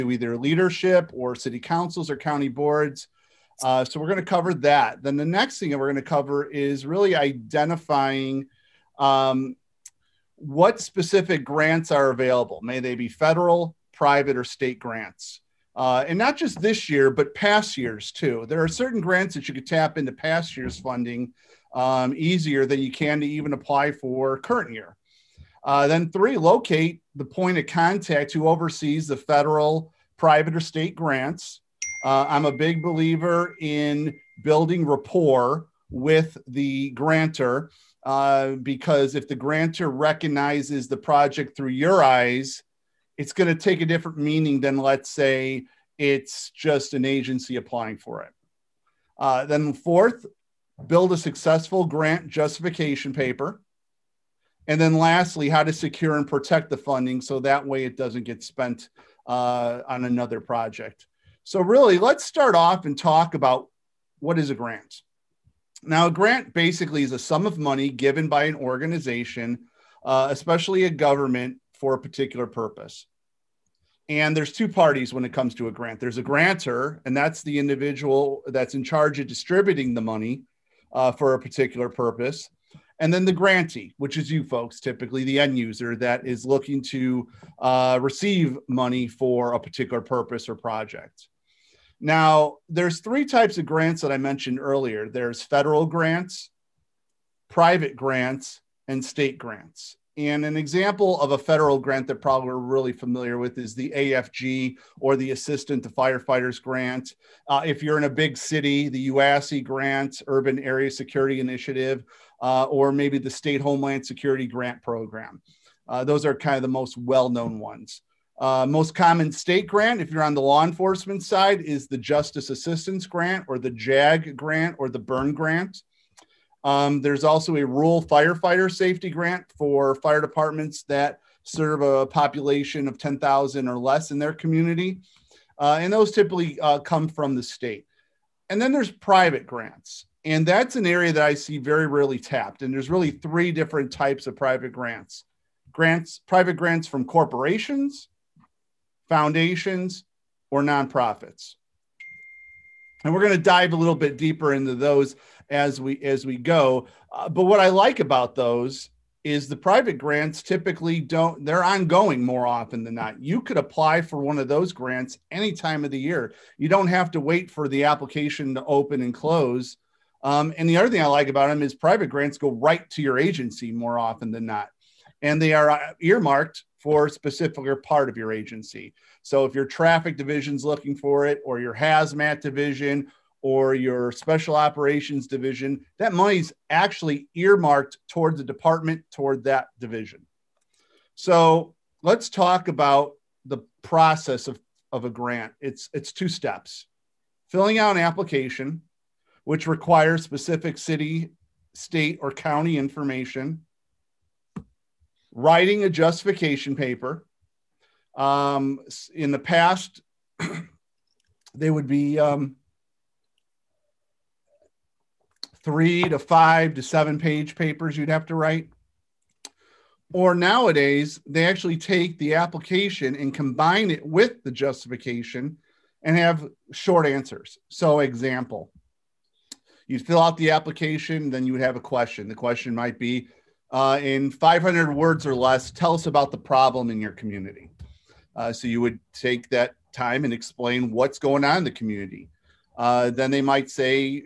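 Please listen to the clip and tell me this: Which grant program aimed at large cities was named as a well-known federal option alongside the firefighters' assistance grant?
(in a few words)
UASI.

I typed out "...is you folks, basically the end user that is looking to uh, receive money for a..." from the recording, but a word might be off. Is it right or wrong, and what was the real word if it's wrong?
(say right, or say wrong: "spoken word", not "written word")
wrong: "typically", not "basically".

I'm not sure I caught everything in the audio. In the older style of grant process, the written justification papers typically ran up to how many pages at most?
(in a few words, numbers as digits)
7.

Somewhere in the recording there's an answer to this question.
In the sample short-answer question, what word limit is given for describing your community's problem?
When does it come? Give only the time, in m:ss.
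3:54.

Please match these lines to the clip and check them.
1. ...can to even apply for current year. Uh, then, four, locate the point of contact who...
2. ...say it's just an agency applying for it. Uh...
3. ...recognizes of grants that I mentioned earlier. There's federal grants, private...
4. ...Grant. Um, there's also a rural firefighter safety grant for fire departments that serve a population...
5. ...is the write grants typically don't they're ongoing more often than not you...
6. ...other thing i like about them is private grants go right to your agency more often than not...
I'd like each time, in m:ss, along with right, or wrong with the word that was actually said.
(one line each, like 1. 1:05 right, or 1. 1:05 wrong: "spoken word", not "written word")
1. 0:22 wrong: "three", not "four"
2. 0:45 right
3. 1:33 wrong: "types", not "recognizes"
4. 2:05 right
5. 2:39 wrong: "private", not "write"
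6. 2:50 right.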